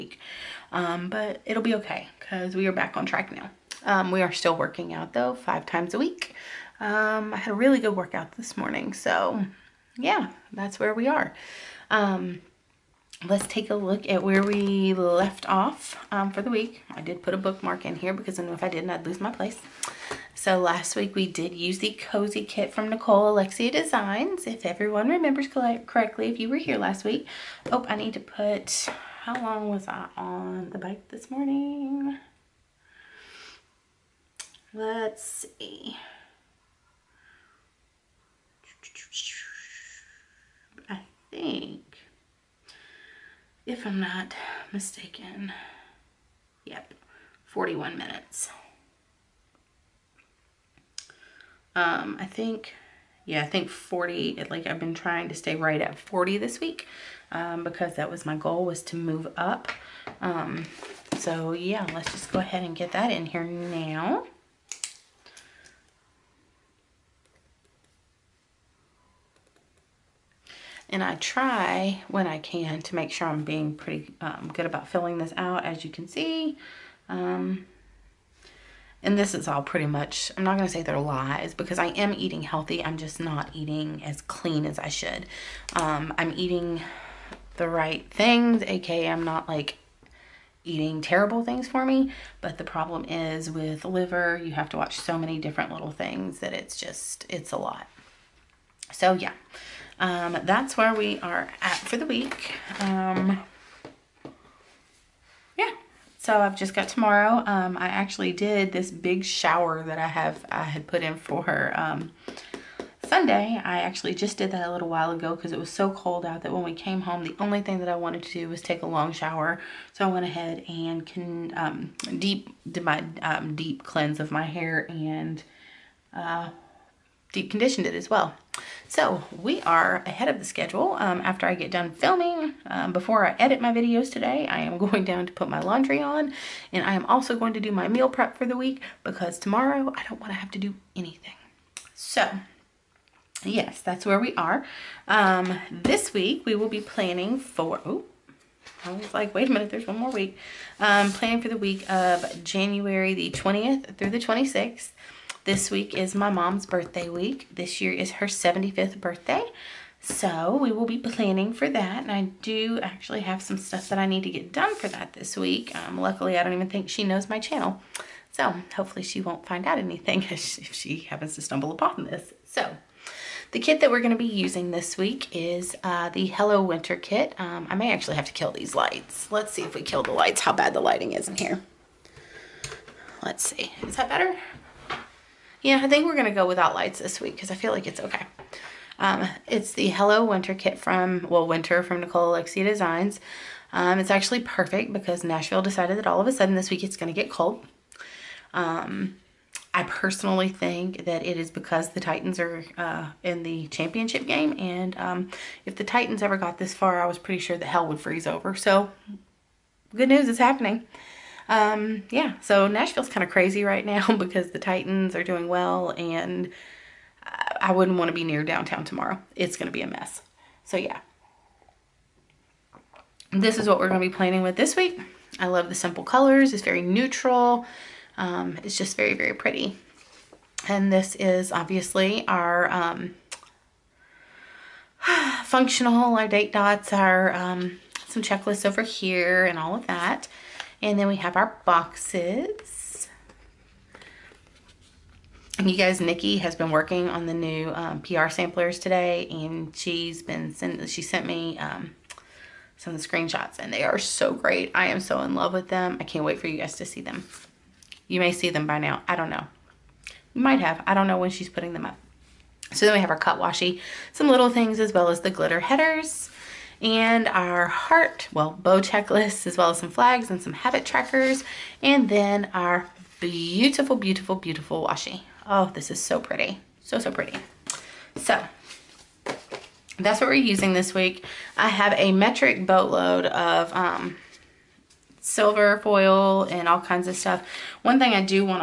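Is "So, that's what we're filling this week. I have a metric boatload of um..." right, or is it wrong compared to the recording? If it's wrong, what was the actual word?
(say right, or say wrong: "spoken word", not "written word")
wrong: "using", not "filling".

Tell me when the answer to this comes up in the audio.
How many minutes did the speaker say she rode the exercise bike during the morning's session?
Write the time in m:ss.
0:47.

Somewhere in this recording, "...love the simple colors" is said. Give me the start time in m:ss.
3:45.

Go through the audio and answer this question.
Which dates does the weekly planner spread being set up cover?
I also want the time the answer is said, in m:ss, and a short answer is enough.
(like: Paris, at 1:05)
January 20th through 26th, at 2:32.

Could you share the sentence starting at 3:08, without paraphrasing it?
Um, it's the Hello Winter kit from, well, Winter from Nicole Alexia Designs.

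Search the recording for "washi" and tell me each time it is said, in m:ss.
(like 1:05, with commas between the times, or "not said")
4:23, 4:34.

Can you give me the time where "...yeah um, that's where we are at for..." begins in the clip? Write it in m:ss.
1:39.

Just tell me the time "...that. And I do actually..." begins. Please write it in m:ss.
2:41.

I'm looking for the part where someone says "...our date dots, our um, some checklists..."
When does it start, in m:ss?
3:56.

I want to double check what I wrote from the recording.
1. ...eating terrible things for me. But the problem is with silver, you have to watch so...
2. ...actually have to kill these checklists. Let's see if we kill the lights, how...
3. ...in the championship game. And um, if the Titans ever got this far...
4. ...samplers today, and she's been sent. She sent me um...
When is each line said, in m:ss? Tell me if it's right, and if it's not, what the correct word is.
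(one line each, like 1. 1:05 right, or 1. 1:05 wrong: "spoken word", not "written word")
1. 1:30 wrong: "liver", not "silver"
2. 2:57 wrong: "lights", not "checklists"
3. 3:23 right
4. 4:08 right.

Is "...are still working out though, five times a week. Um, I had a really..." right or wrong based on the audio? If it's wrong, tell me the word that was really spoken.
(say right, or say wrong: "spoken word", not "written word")
right.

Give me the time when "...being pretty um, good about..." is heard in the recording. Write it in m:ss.
1:13.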